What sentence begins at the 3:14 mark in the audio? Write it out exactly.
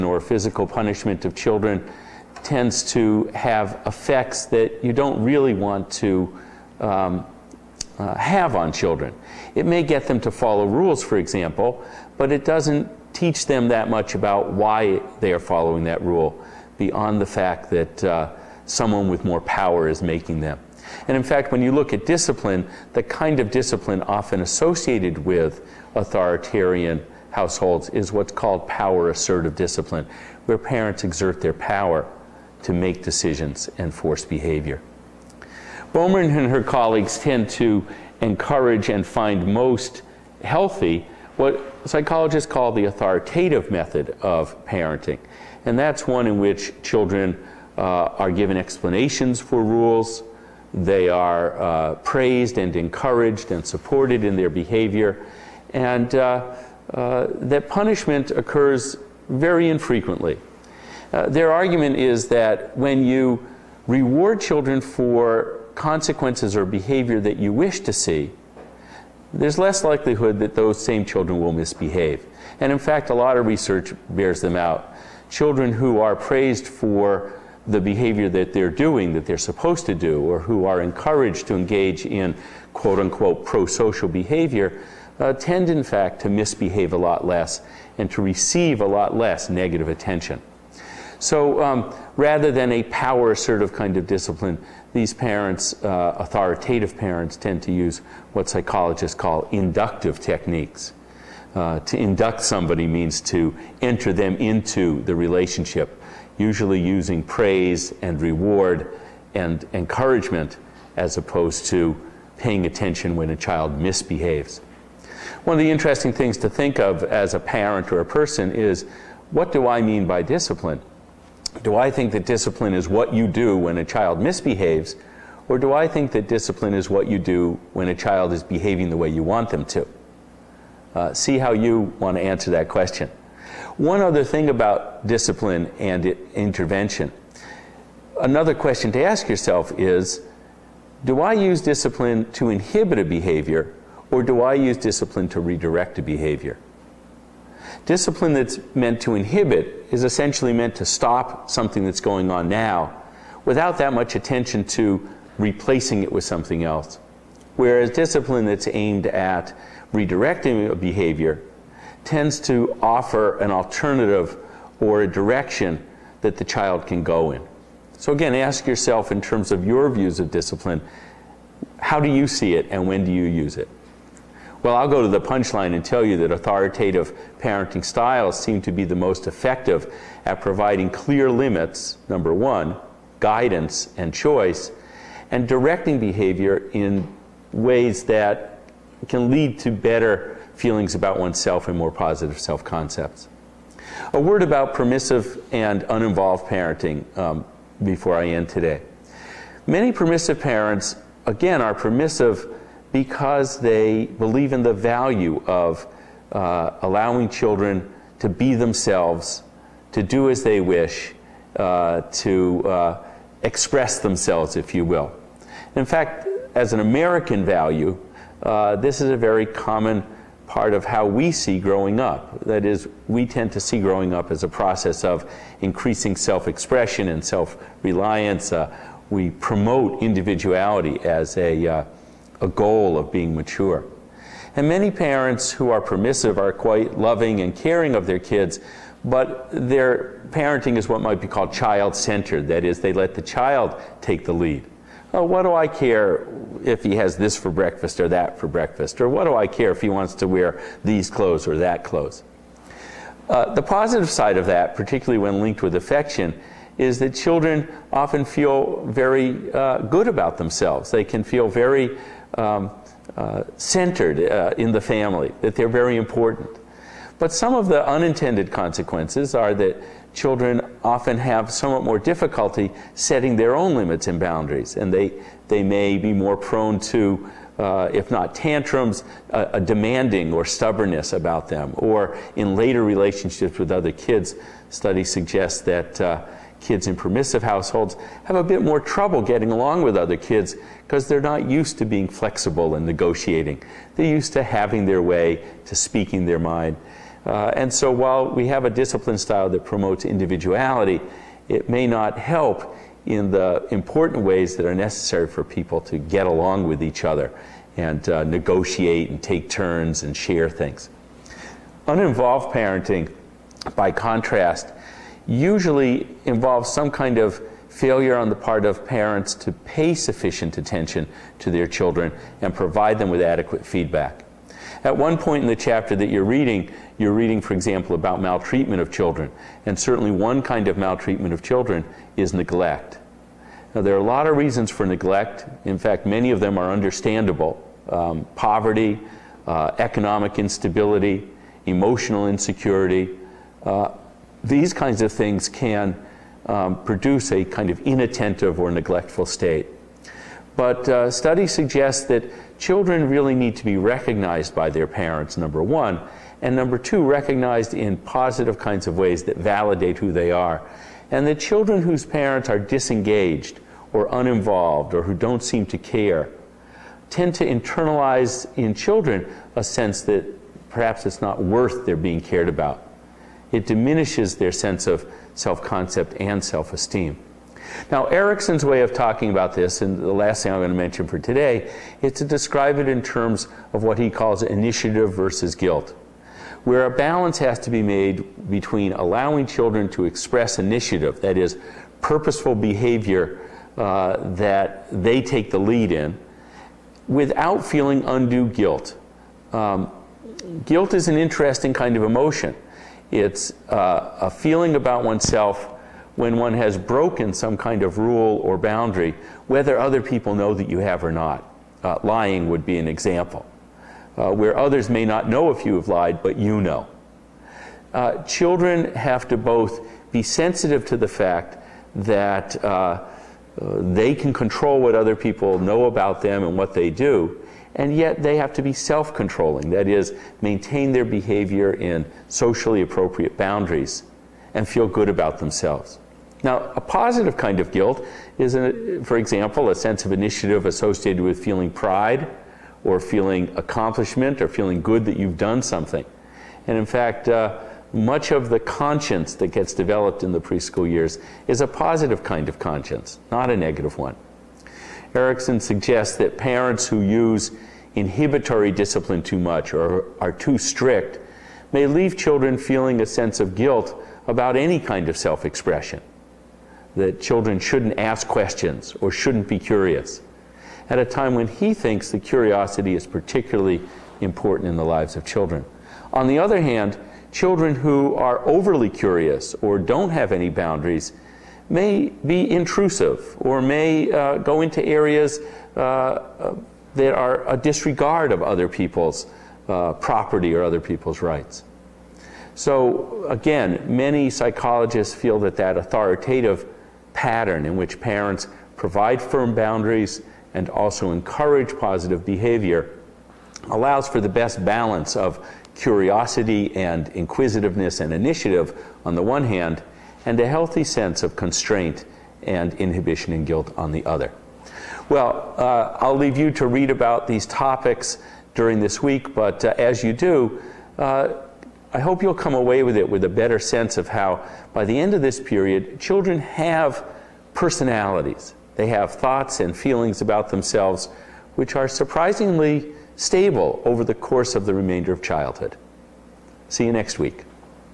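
A word about permissive and uninvolved parenting um, before I end today.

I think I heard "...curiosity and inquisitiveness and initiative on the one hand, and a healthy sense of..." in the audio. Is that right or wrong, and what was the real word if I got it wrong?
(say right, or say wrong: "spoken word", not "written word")
right.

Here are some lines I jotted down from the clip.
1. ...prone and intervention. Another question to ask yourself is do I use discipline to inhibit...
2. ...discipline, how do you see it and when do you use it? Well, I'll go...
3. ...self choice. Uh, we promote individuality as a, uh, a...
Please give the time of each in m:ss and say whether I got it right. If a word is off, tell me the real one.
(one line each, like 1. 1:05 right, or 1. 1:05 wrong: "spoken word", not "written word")
1. 2:15 wrong: "discipline", not "prone"
2. 2:50 right
3. 3:47 wrong: "reliance", not "choice".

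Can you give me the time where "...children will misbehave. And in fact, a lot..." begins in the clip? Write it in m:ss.
1:11.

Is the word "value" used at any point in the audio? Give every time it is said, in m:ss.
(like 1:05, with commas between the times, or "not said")
3:24, 3:37.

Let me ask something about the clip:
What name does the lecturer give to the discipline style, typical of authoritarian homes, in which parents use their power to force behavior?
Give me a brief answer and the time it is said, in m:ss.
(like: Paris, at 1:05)
power assertive discipline, at 0:28.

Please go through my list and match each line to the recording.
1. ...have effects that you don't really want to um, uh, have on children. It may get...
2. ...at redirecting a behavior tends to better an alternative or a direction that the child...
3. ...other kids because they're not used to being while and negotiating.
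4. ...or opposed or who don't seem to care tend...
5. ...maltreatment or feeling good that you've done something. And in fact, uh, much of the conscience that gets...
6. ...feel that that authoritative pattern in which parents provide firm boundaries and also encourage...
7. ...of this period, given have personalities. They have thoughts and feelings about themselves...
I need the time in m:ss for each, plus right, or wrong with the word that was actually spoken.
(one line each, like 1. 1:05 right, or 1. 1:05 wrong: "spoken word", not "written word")
1. 0:03 right
2. 2:39 wrong: "offer", not "better"
3. 4:49 wrong: "flexible", not "while"
4. 6:03 wrong: "uninvolved", not "opposed"
5. 7:23 wrong: "accomplishment", not "maltreatment"
6. 8:15 right
7. 8:45 wrong: "children", not "given".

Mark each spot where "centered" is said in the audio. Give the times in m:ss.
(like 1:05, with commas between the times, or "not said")
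4:01, 4:23.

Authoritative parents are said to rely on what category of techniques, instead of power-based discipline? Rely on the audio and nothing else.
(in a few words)
inductive techniques.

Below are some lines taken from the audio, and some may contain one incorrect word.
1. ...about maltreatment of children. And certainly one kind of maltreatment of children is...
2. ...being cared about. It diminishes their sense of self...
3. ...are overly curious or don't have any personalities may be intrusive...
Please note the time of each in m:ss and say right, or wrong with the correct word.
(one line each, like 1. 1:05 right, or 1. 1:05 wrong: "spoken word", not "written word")
1. 5:27 right
2. 6:11 right
3. 7:58 wrong: "boundaries", not "personalities".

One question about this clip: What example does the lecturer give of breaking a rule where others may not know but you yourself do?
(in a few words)
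lying.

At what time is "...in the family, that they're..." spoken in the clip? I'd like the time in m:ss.
4:24.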